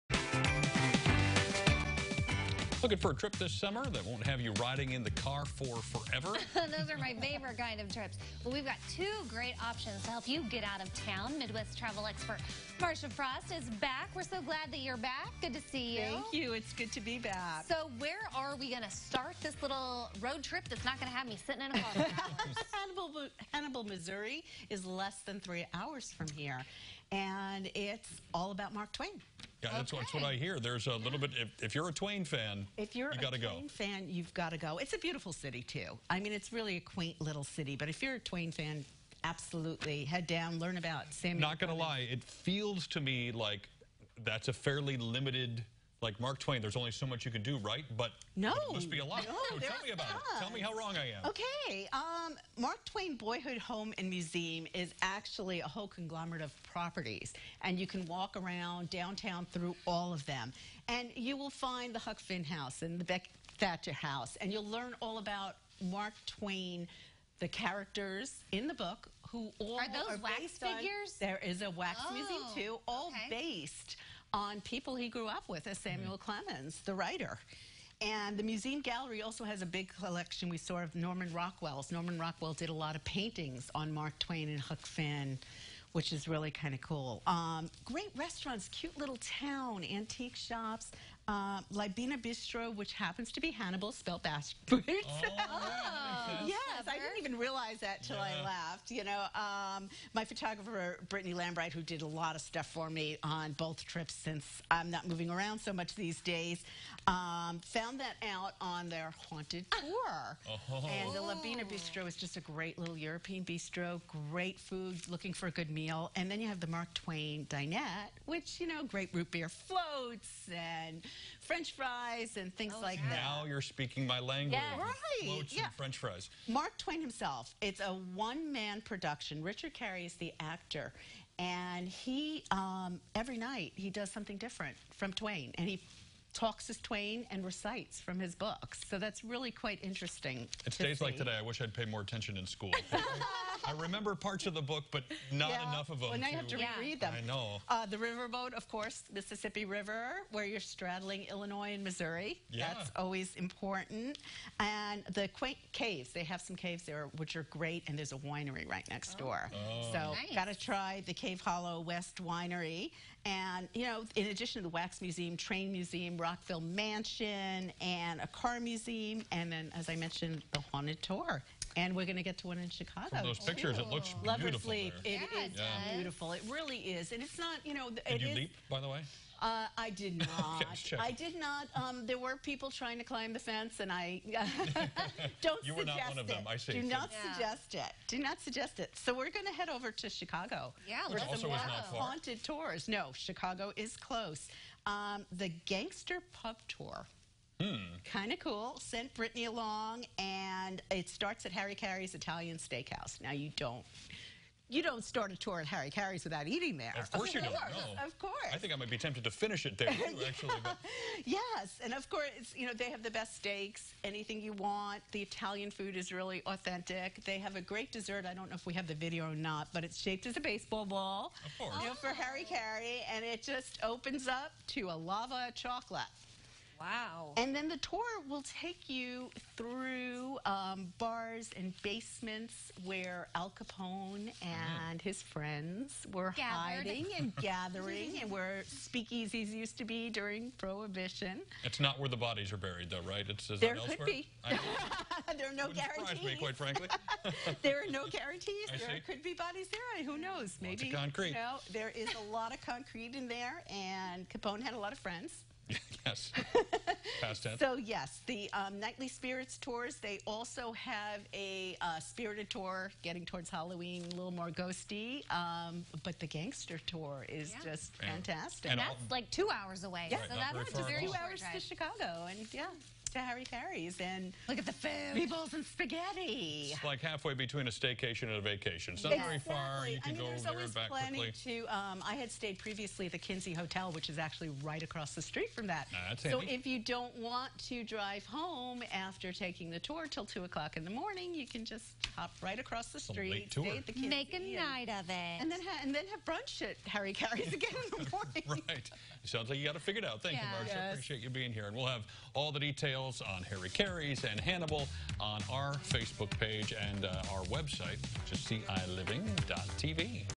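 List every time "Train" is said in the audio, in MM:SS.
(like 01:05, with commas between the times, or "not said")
02:45.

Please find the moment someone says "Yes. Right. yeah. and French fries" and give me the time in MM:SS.
02:04.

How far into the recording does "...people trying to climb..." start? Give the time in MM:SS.
03:02.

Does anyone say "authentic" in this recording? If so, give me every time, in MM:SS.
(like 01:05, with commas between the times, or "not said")
03:36.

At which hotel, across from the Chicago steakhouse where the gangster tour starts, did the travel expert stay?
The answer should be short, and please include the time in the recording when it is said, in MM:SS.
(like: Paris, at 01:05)
Kinzie Hotel, at 04:43.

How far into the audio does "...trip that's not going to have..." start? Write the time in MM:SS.
00:20.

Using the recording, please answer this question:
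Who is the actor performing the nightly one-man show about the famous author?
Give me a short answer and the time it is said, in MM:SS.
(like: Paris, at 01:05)
Richard Garey, at 02:09.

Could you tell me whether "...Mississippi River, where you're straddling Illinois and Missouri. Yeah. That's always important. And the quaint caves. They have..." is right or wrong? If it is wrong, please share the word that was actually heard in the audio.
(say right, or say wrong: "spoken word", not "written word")
right.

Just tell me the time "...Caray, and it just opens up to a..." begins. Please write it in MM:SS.
03:42.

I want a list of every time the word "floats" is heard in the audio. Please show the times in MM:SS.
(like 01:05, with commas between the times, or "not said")
01:59.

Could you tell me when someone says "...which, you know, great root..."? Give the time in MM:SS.
01:58.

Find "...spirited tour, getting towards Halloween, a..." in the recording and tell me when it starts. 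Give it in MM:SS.
04:21.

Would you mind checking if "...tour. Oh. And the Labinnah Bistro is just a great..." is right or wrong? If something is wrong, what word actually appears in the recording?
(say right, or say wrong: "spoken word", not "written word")
right.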